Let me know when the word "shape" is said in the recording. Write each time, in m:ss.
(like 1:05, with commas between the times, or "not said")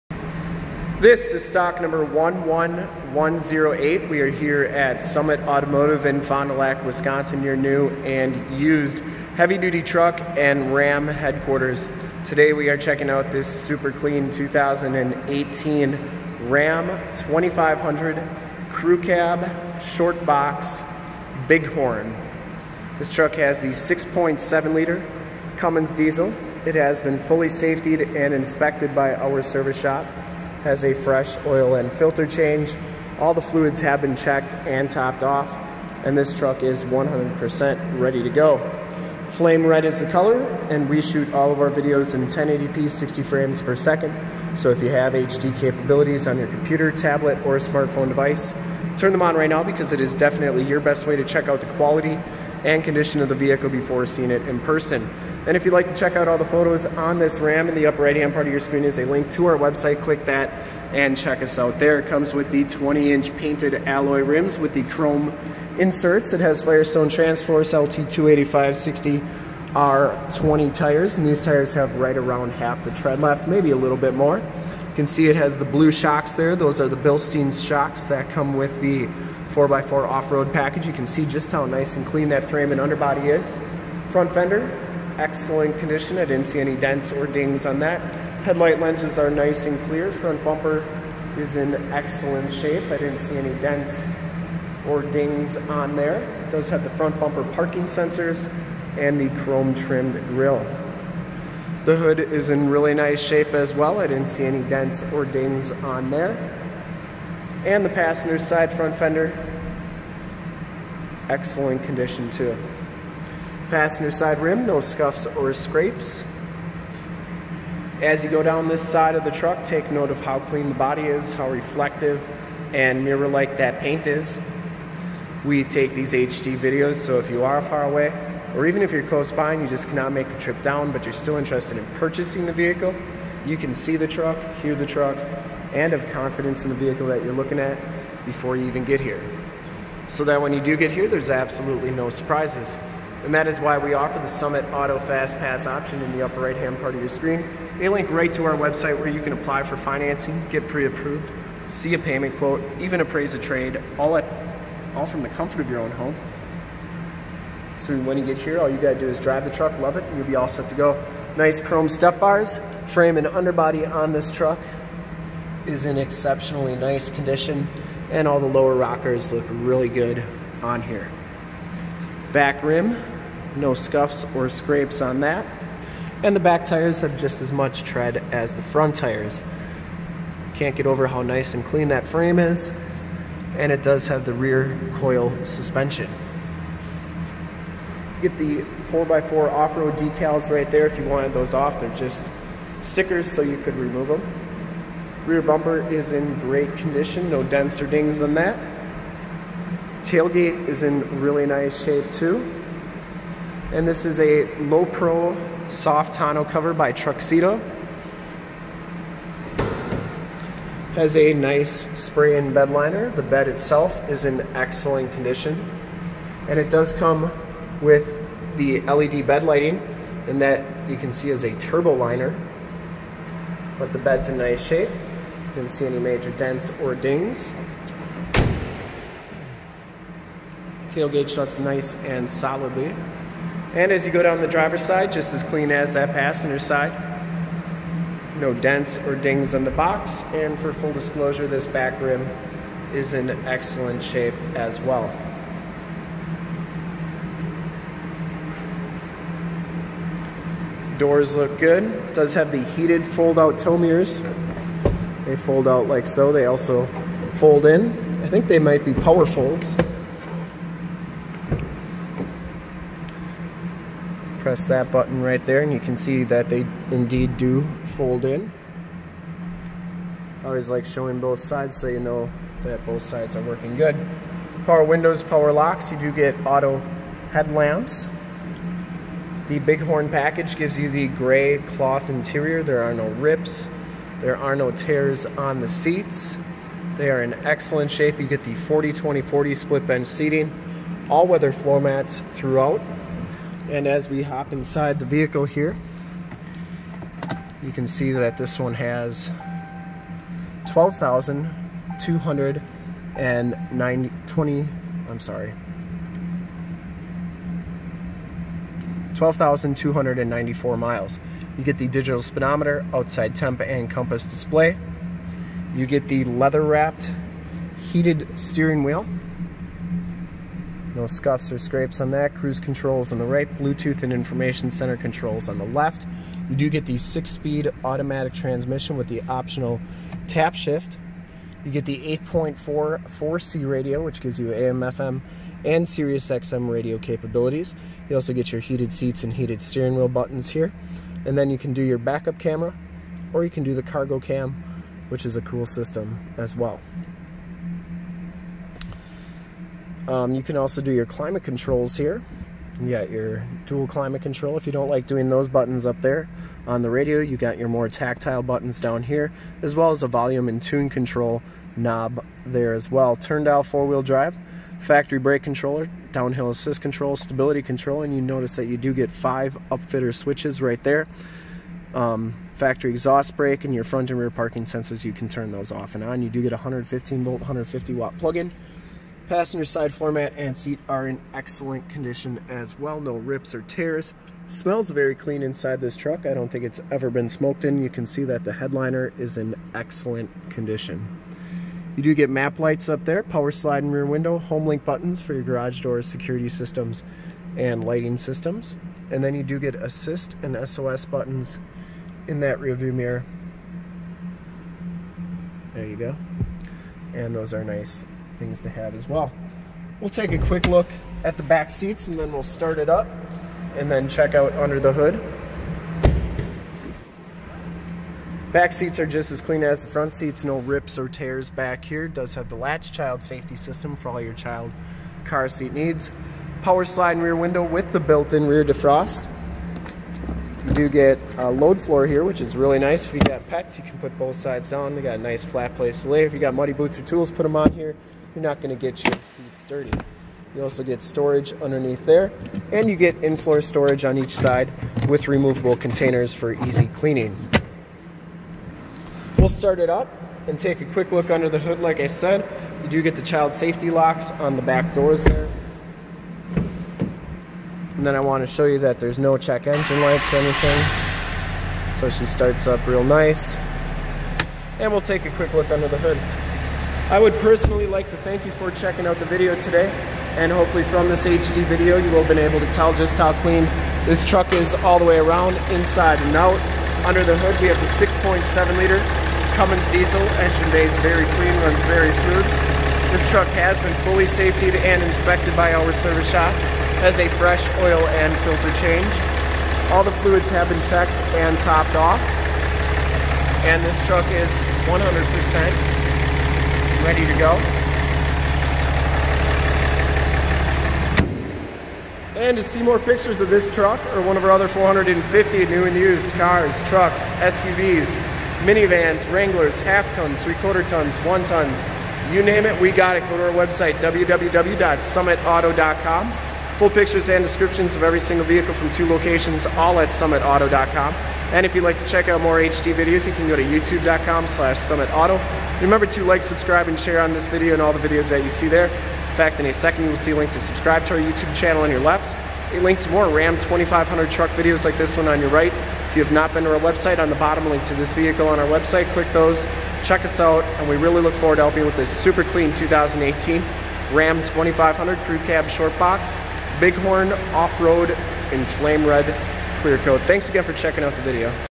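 1:32, 1:43, 3:21, 3:44, 4:04, 4:47.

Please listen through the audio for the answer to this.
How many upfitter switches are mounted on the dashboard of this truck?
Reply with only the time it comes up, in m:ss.
6:09.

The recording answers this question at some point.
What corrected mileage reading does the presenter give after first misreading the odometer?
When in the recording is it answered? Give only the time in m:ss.
5:09.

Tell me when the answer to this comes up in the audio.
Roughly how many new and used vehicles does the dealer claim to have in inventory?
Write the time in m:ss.
8:24.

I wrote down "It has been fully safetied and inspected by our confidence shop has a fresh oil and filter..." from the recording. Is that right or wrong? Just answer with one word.
wrong.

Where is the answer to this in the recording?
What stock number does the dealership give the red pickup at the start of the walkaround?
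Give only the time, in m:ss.
0:01.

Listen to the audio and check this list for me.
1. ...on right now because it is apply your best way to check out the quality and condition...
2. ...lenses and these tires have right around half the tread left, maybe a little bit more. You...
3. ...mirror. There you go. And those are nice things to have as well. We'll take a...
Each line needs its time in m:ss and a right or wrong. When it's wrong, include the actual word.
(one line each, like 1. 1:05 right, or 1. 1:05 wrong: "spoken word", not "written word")
1. 0:49 wrong: "definitely", not "apply"
2. 1:10 wrong: "tires", not "lenses"
3. 6:42 right.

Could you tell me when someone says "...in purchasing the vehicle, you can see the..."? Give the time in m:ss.
2:11.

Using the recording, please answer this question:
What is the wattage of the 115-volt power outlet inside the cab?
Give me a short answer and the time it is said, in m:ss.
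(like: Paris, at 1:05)
150 watts, at 6:17.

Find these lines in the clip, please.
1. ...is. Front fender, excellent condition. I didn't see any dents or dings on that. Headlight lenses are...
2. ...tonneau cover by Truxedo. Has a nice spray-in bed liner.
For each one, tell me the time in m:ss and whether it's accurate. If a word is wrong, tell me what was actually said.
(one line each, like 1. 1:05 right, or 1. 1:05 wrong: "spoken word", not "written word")
1. 1:23 right
2. 3:26 right.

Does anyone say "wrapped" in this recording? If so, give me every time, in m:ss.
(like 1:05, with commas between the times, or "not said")
5:16.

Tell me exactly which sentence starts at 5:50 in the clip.
Um, you can also do your climate controls here.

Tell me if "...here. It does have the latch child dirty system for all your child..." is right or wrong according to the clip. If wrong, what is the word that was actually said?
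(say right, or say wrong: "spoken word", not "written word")
wrong: "safety", not "dirty".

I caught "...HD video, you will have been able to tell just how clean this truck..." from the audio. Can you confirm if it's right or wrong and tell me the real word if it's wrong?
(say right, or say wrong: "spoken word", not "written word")
right.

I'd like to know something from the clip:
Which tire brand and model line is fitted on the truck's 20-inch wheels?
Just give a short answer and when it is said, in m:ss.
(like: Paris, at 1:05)
Firestone Transforce, at 1:06.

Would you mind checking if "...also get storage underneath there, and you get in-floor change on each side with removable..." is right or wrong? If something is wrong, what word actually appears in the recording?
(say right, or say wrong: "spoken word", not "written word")
wrong: "storage", not "change".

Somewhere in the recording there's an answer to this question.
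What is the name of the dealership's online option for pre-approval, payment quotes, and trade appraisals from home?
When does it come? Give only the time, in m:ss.
2:24.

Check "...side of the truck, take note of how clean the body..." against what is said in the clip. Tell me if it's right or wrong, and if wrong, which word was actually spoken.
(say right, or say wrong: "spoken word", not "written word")
right.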